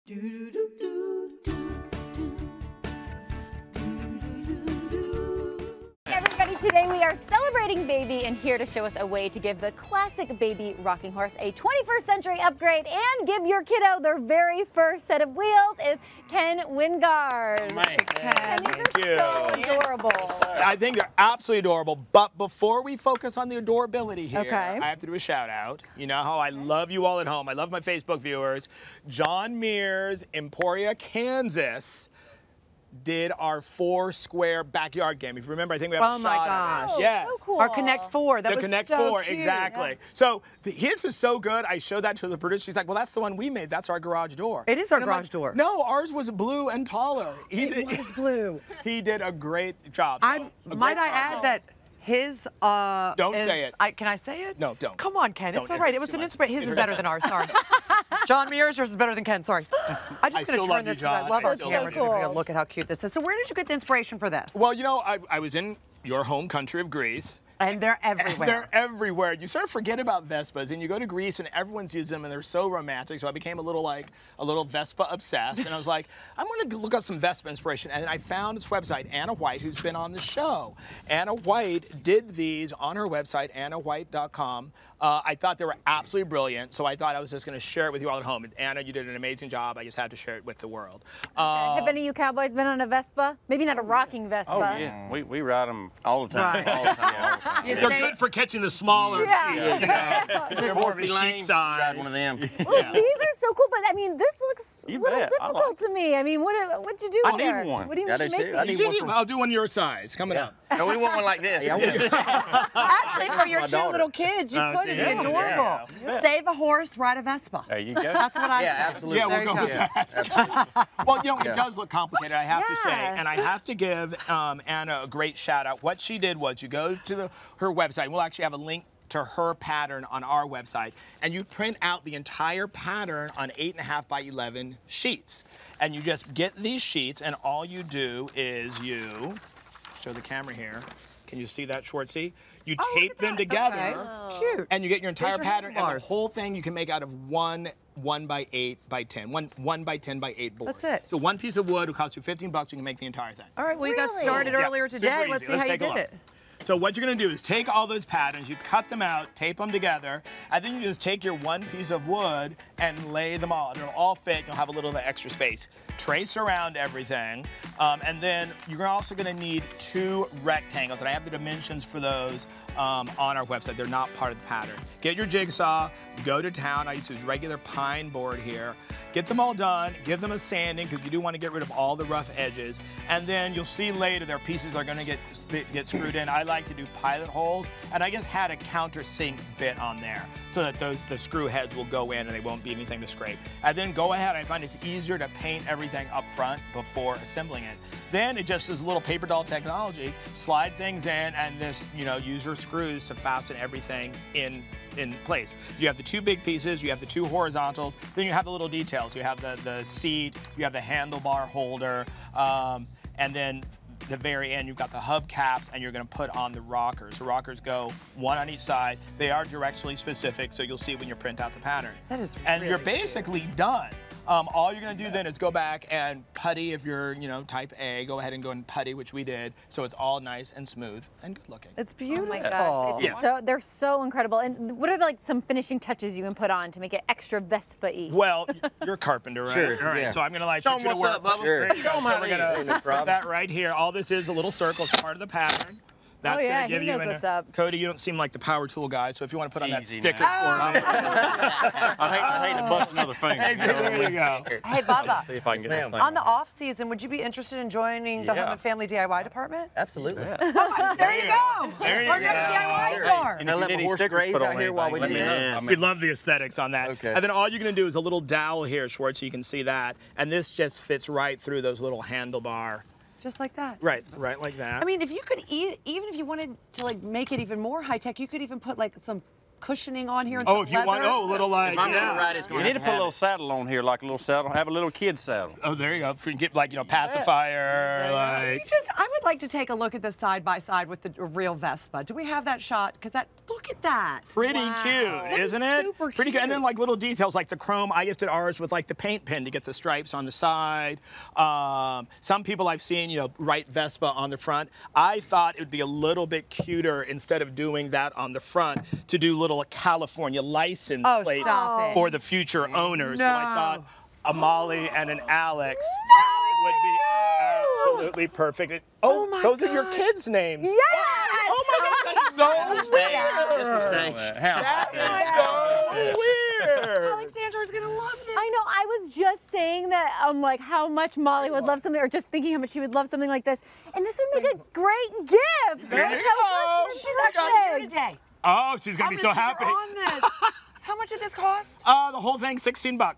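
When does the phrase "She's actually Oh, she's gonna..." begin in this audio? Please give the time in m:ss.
5:36.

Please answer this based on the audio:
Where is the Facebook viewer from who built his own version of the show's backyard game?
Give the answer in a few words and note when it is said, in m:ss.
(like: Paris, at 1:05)
Emporia, Kansas, at 0:30.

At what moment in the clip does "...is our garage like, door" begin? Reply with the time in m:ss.
0:44.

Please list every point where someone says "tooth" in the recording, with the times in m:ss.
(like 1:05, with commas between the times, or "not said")
not said.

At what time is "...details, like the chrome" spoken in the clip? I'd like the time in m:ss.
4:56.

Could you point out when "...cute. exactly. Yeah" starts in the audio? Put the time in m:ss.
0:39.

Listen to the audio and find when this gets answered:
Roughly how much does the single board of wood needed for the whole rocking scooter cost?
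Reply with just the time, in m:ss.
2:32.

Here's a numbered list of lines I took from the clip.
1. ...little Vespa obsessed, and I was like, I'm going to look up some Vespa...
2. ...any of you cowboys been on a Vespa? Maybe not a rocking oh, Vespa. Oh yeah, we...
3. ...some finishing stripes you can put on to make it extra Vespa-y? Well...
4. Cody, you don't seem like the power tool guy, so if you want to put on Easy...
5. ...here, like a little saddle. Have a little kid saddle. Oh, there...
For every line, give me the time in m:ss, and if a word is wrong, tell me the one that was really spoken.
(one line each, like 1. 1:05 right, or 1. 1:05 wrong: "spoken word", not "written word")
1. 1:14 right
2. 1:31 right
3. 3:55 wrong: "touches", not "stripes"
4. 4:07 right
5. 4:43 right.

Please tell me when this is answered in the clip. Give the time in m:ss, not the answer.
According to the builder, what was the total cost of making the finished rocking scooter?
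5:42.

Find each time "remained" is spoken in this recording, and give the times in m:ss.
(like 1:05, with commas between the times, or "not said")
not said.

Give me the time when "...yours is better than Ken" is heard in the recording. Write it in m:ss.
0:58.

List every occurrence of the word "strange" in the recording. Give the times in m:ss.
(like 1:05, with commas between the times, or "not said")
5:22.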